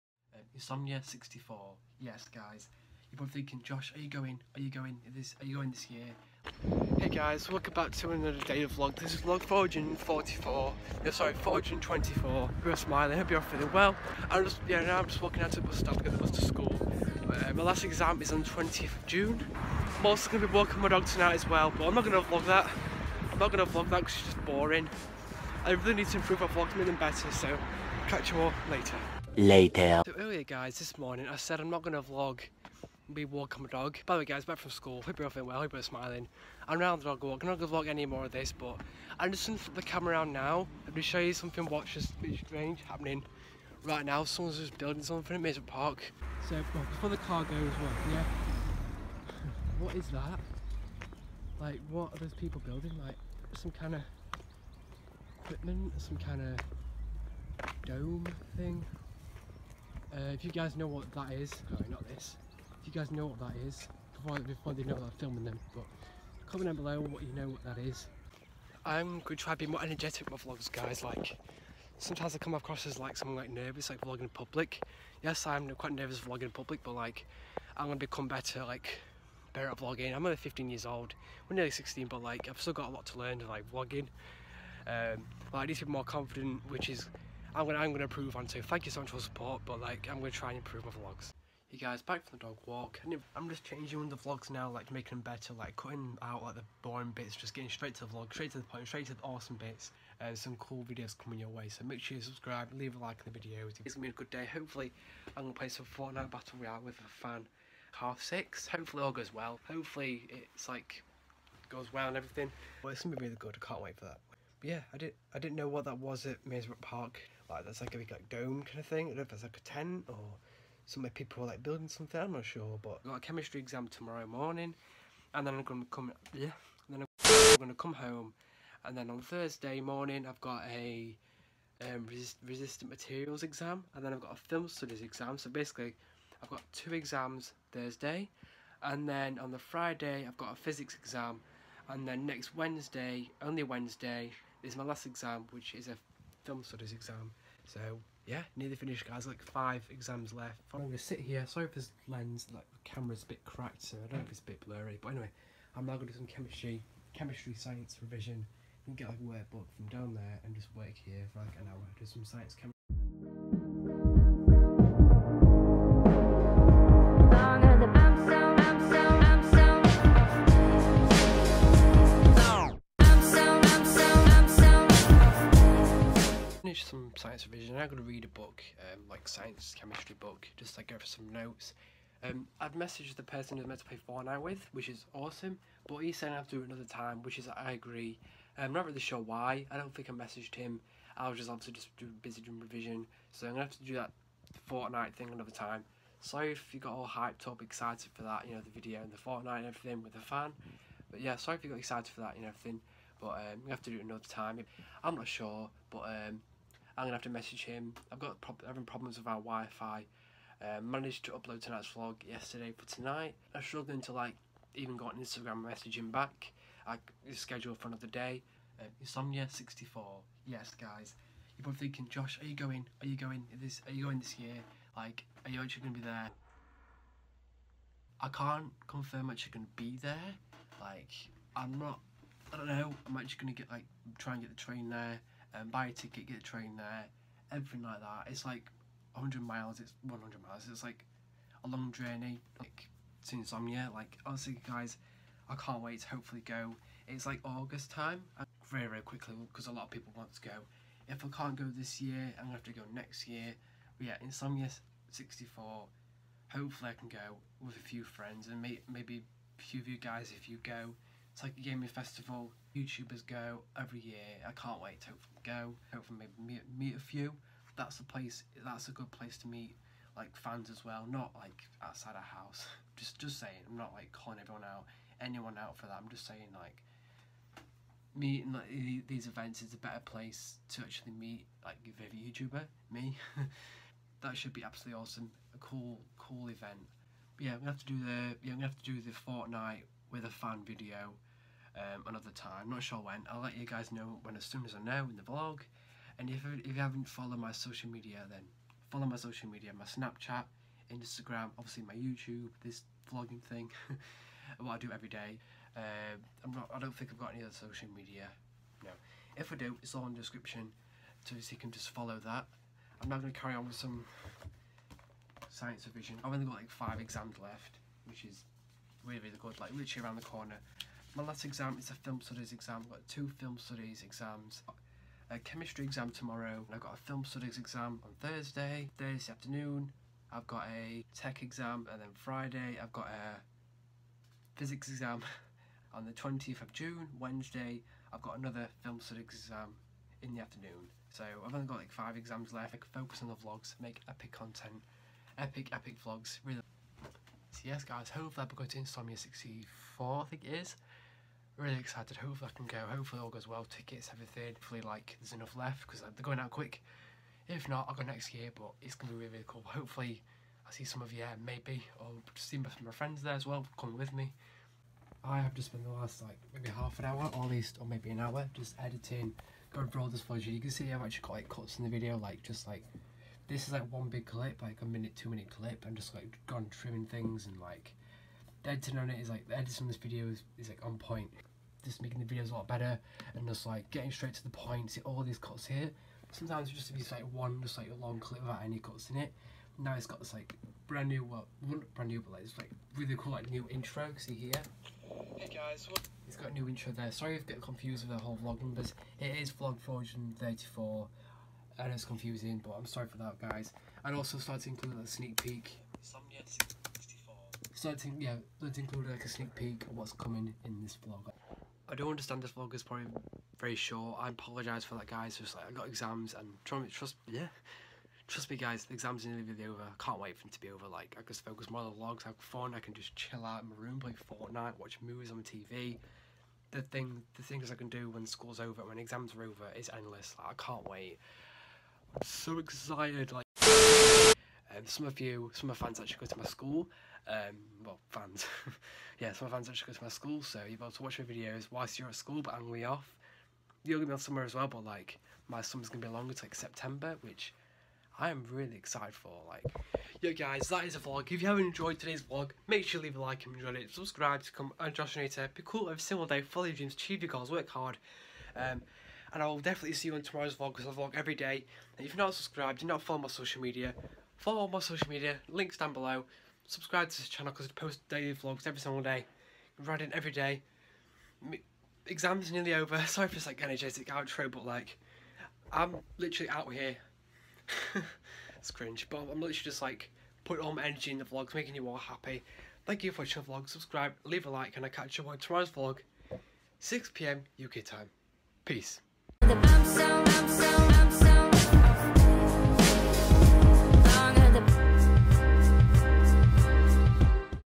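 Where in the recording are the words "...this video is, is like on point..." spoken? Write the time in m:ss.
6:19.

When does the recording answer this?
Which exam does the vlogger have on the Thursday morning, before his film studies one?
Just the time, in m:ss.
2:12.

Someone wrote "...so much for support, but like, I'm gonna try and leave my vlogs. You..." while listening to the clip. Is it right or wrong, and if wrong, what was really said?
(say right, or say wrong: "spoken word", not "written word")
wrong: "improve", not "leave".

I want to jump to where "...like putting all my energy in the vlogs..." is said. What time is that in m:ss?
7:59.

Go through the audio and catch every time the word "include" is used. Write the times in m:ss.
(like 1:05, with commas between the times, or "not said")
6:44, 6:48.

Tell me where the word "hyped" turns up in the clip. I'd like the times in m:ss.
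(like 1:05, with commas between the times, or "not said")
3:17.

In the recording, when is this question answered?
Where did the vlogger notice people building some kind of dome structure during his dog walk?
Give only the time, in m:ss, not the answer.
0:45.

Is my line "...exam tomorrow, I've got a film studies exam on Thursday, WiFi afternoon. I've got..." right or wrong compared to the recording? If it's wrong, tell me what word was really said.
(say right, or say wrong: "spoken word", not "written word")
wrong: "Thursday", not "WiFi".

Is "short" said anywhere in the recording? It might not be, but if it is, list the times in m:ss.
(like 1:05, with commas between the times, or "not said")
6:53.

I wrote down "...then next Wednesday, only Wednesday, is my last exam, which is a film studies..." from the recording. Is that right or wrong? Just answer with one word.
right.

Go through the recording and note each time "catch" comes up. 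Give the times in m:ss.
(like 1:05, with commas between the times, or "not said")
0:28, 8:04.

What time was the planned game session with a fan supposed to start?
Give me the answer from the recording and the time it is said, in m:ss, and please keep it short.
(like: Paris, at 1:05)
Half six, at 1:47.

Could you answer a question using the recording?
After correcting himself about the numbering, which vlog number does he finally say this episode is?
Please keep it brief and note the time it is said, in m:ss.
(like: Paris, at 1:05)
434, at 6:39.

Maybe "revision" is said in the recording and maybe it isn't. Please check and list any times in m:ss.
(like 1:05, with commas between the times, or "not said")
2:38, 2:57, 3:12, 5:15.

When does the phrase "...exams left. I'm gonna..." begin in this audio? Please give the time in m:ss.
2:29.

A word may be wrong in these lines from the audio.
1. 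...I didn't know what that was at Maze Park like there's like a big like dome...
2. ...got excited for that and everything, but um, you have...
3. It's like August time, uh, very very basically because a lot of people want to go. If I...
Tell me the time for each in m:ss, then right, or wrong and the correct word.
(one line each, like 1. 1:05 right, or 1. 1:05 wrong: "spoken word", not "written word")
1. 1:55 right
2. 3:21 right
3. 4:07 wrong: "quickly", not "basically".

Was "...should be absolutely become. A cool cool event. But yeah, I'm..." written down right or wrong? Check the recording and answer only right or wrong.
wrong.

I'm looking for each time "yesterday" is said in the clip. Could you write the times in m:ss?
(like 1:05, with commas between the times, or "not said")
3:32.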